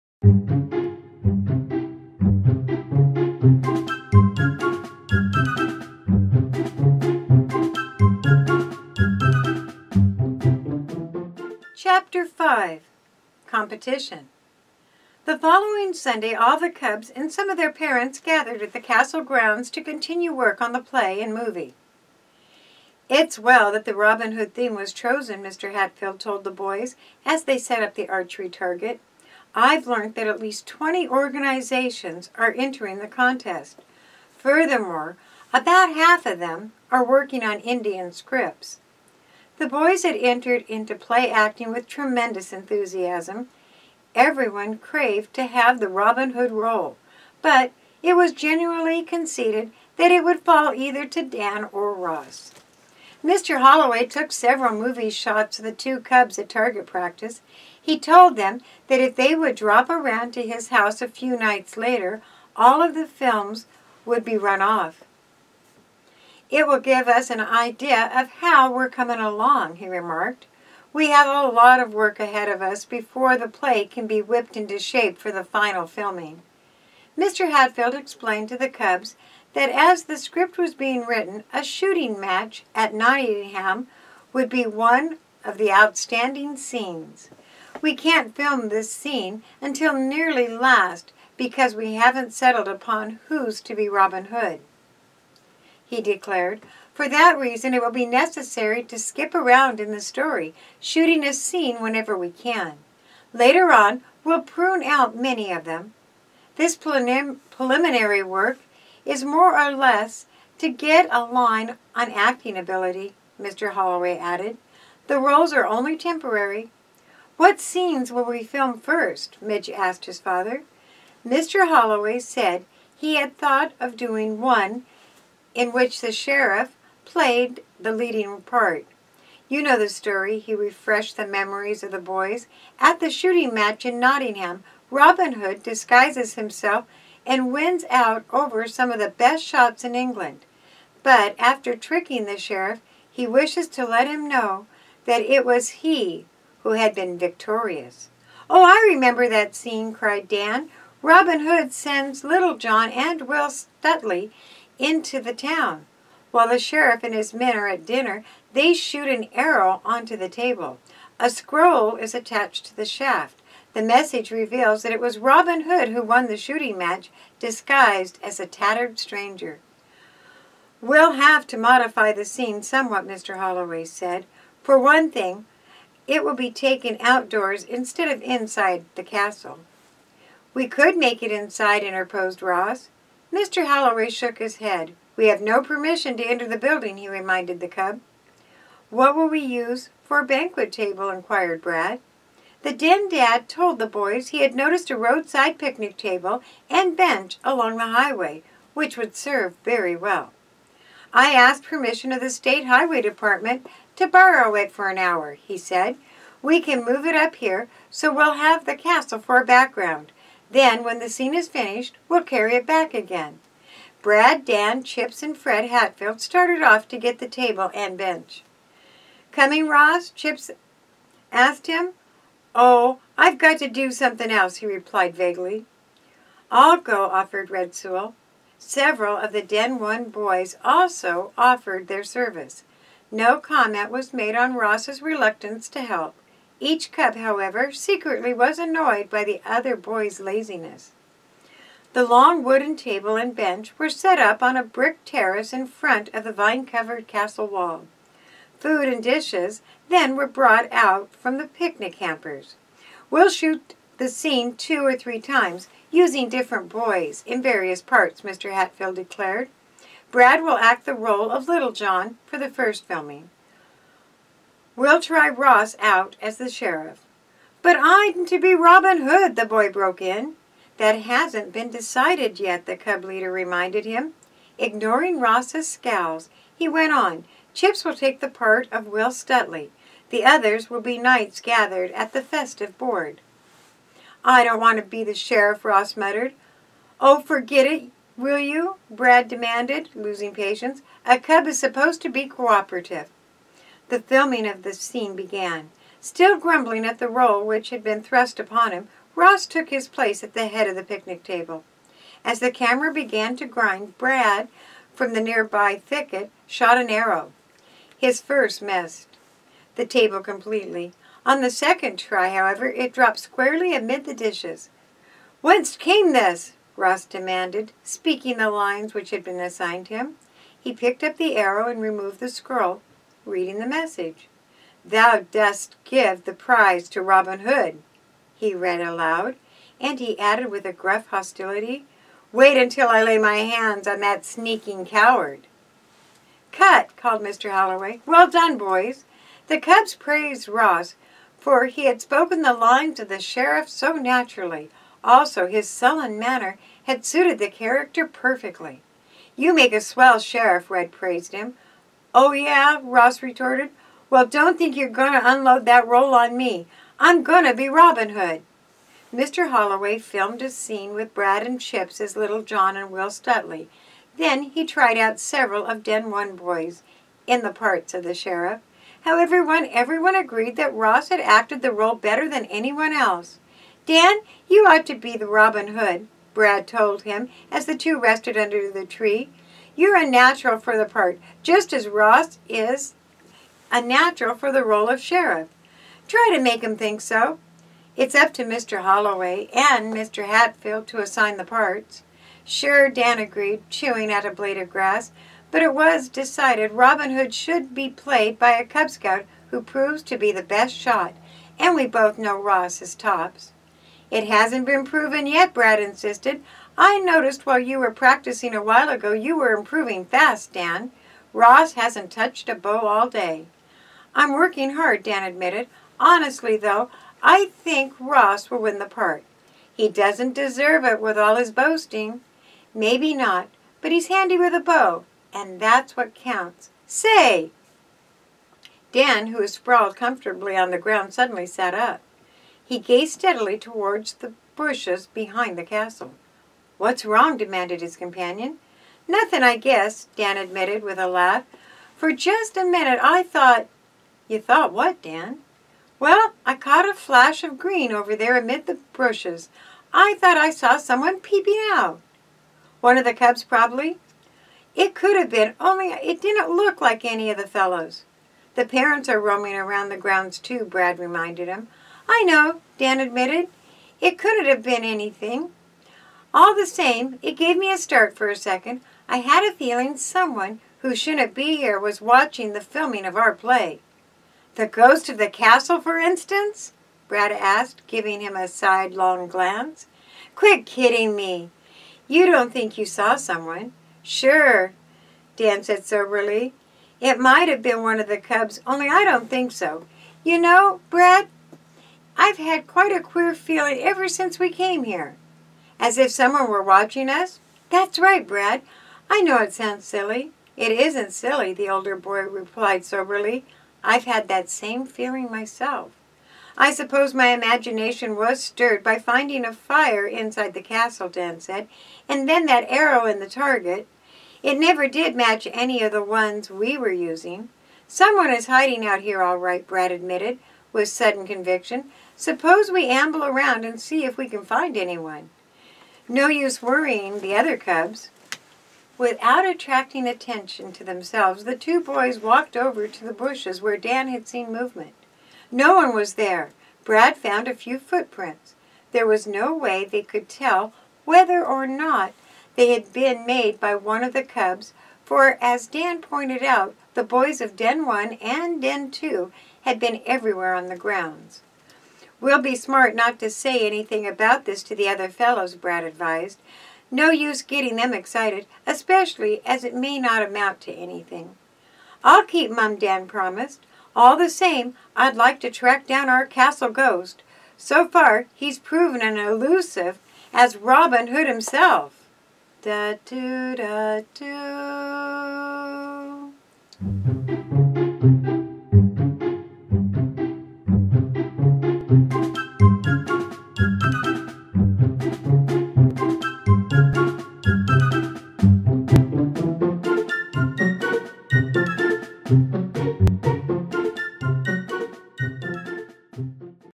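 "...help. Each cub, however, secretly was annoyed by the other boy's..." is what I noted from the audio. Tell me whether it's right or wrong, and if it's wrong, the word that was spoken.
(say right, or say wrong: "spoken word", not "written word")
right.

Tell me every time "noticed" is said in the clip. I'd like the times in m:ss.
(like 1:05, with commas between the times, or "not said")
3:14, 6:46.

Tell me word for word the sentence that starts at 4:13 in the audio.
We'll shoot the scene two or three times using different boys in various parts, Mr.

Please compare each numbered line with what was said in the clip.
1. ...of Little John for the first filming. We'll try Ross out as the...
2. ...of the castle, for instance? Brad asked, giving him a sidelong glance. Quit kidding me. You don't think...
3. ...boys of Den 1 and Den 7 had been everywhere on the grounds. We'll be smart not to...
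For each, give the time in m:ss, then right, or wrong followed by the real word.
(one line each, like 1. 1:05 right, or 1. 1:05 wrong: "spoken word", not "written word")
1. 4:21 right
2. 7:55 right
3. 9:07 wrong: "2", not "7".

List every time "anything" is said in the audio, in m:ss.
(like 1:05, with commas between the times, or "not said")
7:44, 9:13, 9:20.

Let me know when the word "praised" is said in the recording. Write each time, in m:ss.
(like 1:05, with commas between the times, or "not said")
5:39, 5:50.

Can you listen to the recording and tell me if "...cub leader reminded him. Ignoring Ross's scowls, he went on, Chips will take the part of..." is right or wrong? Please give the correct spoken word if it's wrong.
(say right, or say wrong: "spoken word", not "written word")
right.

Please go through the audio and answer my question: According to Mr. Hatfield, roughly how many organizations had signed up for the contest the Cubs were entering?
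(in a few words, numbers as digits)
20.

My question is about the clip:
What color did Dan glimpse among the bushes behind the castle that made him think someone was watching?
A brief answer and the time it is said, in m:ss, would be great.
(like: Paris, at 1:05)
Green, at 7:27.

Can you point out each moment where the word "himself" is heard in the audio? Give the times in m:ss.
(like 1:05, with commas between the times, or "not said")
2:16, 9:31.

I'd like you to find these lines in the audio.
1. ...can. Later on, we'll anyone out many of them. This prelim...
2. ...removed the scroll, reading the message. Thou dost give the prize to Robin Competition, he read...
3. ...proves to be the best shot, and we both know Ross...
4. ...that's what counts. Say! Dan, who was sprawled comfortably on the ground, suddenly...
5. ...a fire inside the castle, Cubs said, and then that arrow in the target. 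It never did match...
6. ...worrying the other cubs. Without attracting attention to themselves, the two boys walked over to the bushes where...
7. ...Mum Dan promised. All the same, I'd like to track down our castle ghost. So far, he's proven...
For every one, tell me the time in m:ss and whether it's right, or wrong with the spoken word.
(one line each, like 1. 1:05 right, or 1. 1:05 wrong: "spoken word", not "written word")
1. 1:42 wrong: "prune", not "anyone"
2. 5:21 wrong: "Hood", not "Competition"
3. 6:39 right
4. 7:05 right
5. 8:29 wrong: "Dan", not "Cubs"
6. 8:46 right
7. 9:22 right.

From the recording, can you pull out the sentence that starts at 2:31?
Robin Hood sends Little John and Will Stutely into the town.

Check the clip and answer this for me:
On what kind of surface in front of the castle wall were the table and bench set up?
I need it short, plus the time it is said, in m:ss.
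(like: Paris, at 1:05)
A brick terrace, at 4:04.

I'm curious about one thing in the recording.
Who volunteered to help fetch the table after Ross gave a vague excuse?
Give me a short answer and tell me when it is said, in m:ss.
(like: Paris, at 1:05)
Red Sewell, at 3:47.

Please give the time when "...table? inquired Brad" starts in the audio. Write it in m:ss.
3:10.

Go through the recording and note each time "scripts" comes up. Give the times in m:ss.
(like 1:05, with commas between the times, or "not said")
0:38, 1:20.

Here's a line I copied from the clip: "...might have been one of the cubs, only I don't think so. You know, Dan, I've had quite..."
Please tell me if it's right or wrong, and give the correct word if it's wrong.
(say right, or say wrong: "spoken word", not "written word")
wrong: "Brad", not "Dan".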